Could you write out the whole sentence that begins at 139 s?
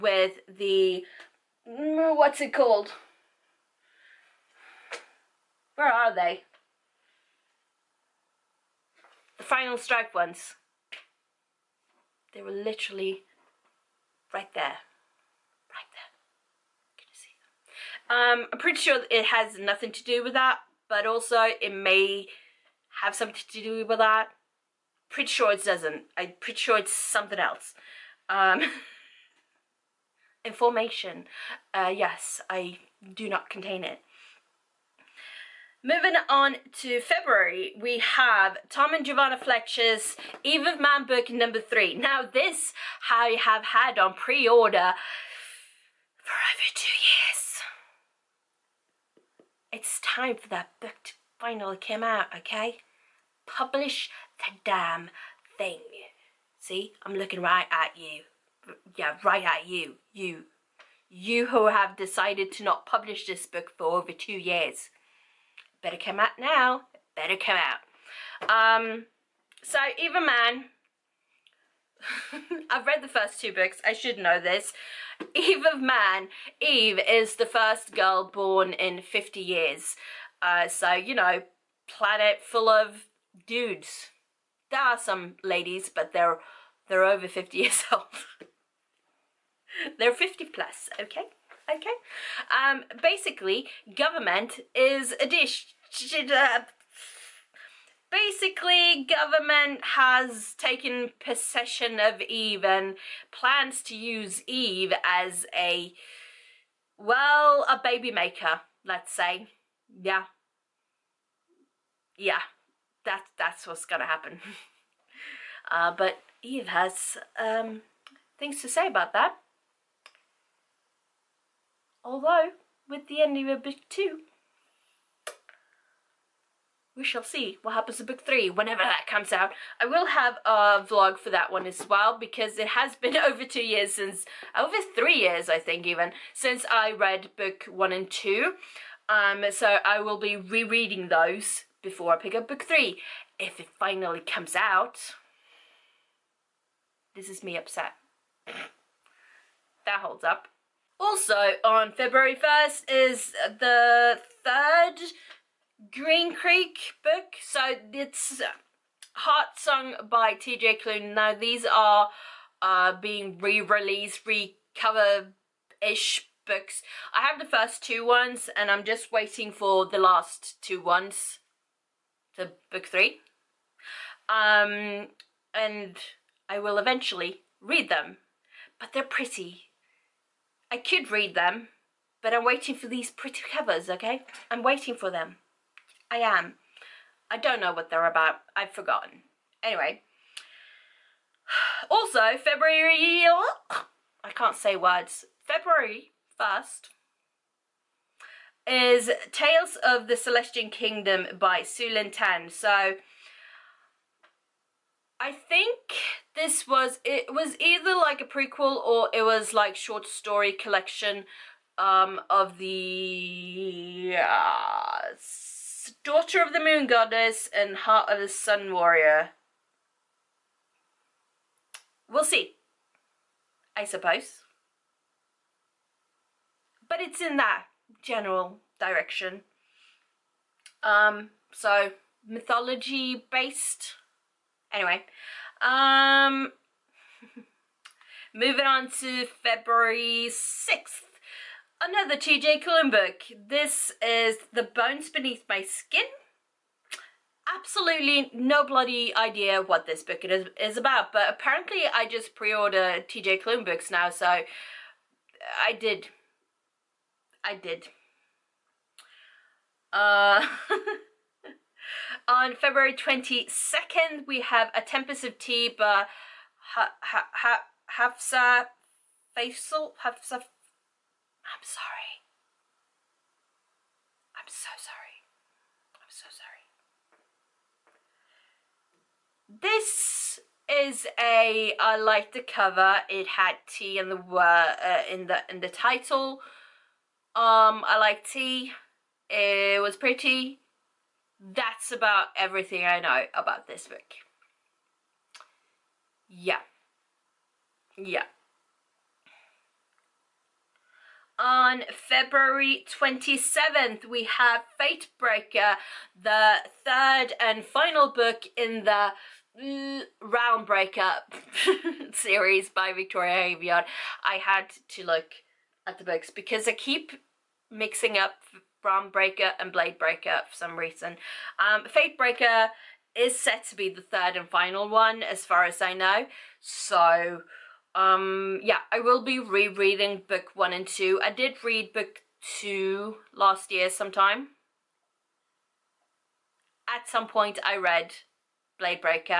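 Um, so I will be rereading those before I pick up book three.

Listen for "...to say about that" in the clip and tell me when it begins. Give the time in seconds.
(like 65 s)
118 s.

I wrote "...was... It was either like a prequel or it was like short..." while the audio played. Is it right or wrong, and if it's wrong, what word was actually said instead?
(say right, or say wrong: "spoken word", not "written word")
right.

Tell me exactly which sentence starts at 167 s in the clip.
I have the first two ones and I'm just waiting for the last two ones.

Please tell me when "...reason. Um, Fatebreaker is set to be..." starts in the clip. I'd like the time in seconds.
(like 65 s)
320 s.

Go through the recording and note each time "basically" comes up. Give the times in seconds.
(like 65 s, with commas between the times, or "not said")
93 s, 98 s.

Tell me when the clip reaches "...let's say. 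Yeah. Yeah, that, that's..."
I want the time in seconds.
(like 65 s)
108 s.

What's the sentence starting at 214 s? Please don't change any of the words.
Uh, Daughter of the Moon Goddess and Heart of the Sun Warrior.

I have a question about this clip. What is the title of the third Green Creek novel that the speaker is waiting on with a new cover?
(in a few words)
Heart Song.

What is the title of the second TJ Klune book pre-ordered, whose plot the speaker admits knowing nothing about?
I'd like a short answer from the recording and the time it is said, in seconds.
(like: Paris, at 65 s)
The Bones Beneath My Skin, at 244 s.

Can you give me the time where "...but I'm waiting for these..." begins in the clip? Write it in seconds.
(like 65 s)
182 s.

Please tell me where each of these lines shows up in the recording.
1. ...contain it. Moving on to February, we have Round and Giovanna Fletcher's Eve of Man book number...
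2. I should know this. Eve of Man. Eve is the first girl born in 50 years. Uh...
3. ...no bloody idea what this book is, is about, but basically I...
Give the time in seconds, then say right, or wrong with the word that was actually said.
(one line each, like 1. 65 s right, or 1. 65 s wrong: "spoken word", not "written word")
1. 33 s wrong: "Tom", not "Round"
2. 73 s right
3. 248 s wrong: "apparently", not "basically".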